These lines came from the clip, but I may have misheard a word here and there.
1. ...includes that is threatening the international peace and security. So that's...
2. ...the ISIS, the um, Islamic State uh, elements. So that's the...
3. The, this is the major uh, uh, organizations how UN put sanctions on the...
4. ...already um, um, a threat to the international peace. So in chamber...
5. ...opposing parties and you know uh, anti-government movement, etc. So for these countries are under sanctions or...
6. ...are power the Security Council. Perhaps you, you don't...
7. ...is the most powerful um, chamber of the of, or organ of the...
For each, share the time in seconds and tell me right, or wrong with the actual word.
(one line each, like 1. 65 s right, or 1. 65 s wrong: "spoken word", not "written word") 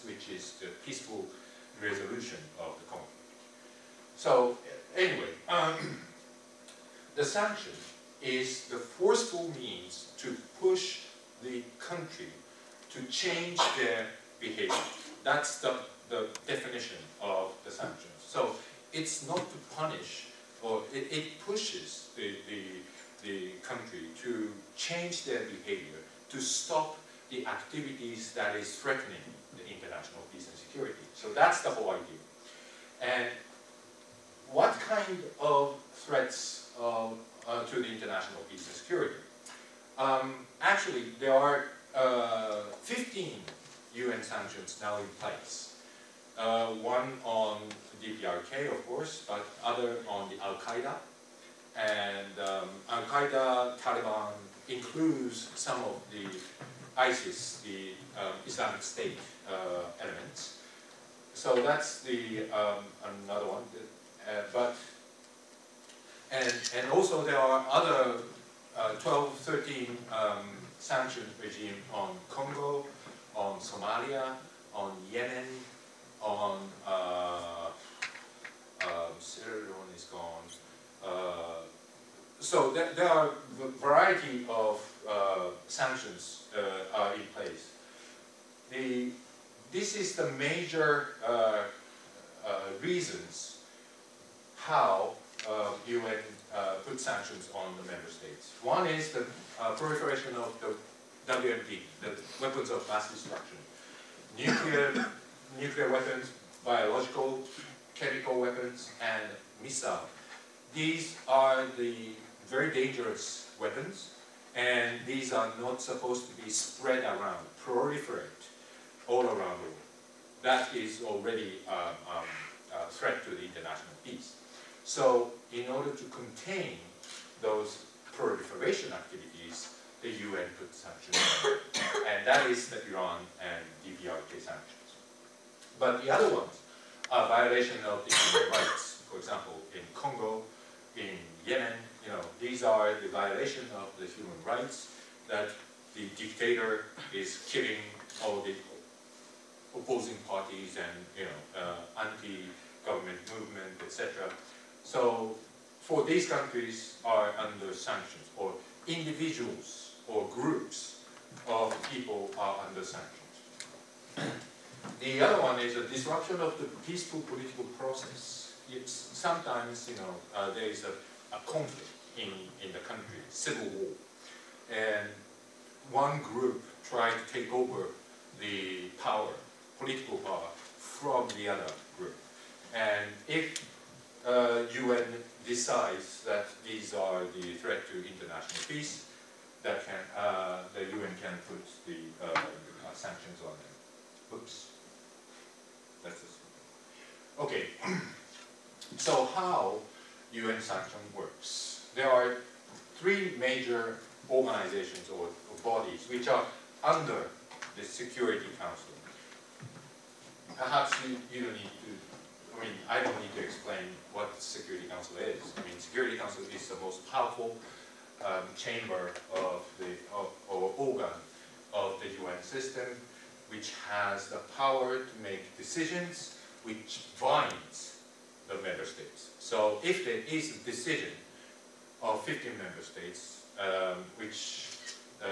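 1. 27 s wrong: "activities", not "includes"
2. 56 s right
3. 88 s wrong: "reasons", not "organizations"
4. 121 s wrong: "order", not "chamber"
5. 149 s right
6. 206 s wrong: "under", not "power"
7. 216 s right.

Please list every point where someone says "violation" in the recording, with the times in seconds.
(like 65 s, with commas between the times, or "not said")
137 s, 143 s.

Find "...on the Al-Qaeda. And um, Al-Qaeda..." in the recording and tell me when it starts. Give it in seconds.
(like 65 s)
50 s.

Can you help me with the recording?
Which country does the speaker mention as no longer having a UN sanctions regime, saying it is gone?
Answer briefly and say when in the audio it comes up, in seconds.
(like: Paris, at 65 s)
Sierra Leone, at 79 s.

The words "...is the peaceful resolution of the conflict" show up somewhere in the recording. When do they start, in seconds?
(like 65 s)
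0 s.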